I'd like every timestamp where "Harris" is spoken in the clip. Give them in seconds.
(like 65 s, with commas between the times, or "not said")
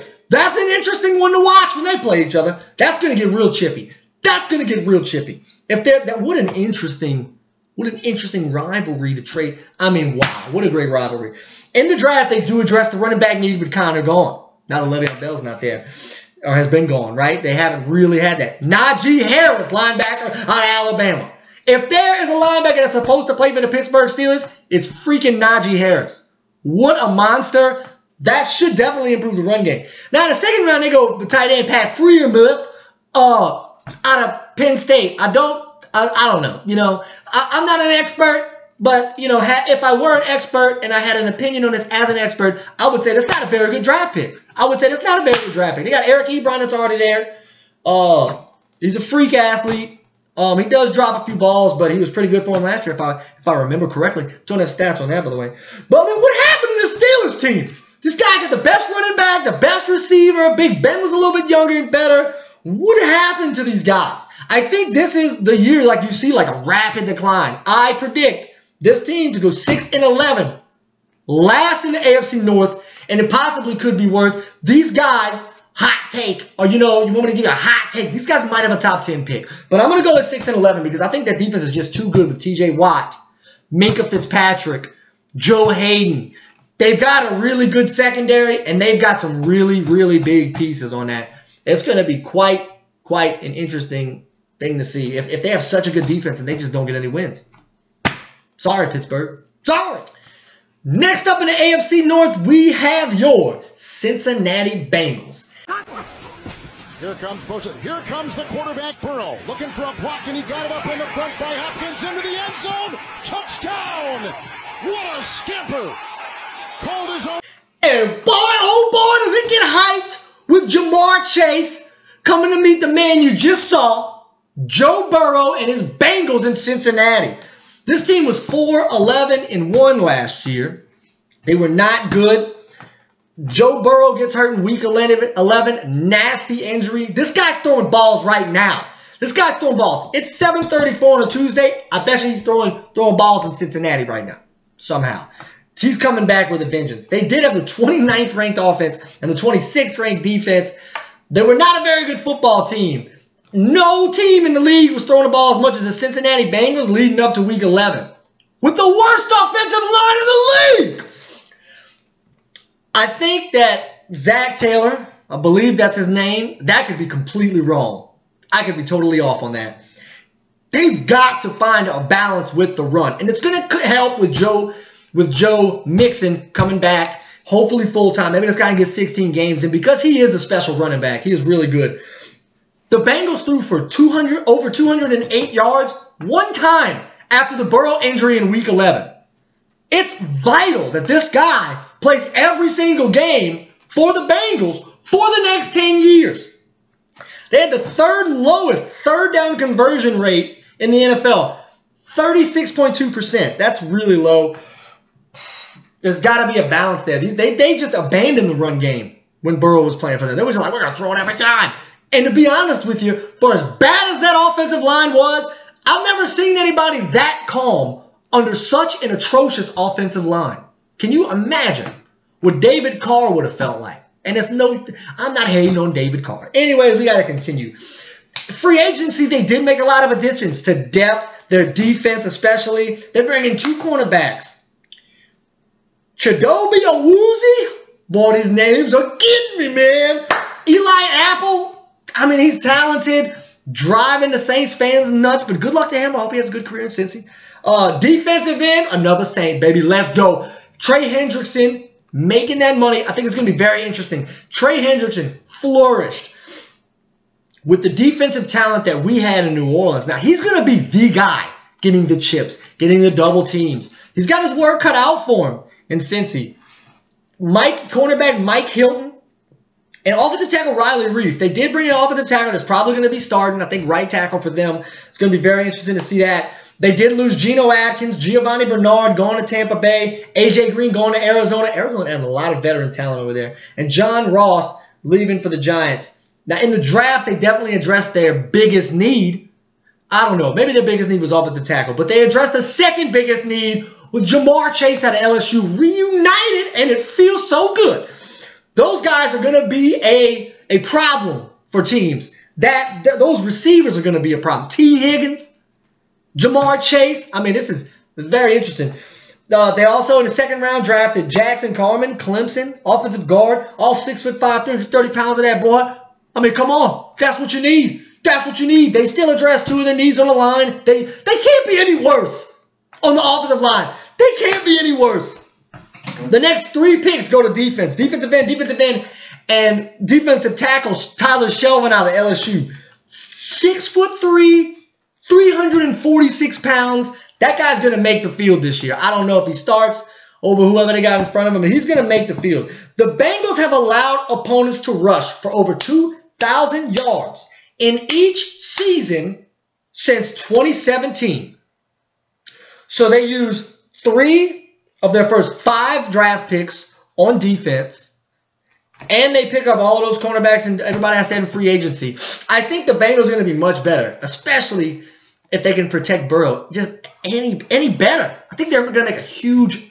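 19 s, 25 s.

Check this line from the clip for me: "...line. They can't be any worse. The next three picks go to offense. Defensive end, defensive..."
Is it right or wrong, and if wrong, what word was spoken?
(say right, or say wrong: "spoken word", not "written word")
wrong: "defense", not "offense".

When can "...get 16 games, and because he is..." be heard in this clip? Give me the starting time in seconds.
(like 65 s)
178 s.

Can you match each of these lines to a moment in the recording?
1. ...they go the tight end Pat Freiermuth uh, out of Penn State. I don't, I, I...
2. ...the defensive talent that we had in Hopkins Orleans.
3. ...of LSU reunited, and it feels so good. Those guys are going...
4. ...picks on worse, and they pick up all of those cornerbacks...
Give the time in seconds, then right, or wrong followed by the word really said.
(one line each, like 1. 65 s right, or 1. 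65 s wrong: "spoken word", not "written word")
1. 30 s right
2. 257 s wrong: "New", not "Hopkins"
3. 295 s right
4. 356 s wrong: "defense", not "worse".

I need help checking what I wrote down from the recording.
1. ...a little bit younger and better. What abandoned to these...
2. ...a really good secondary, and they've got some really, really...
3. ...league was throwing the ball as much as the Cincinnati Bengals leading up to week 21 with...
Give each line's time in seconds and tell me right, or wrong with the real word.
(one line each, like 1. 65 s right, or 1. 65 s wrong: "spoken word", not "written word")
1. 61 s wrong: "happened", not "abandoned"
2. 87 s right
3. 154 s wrong: "11", not "21".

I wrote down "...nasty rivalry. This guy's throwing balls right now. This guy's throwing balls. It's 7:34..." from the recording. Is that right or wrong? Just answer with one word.
wrong.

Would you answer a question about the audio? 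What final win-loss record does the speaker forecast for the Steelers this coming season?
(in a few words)
6 and 11.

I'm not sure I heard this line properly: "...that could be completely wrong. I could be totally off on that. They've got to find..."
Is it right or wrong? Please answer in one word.
right.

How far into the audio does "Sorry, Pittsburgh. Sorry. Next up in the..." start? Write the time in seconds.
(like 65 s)
98 s.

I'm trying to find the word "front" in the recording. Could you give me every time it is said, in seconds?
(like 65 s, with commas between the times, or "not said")
111 s, 341 s.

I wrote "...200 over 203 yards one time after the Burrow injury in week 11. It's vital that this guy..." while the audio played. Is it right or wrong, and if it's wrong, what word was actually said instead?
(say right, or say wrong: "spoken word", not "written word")
wrong: "208", not "203".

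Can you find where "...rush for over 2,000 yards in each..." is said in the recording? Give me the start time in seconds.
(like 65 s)
344 s.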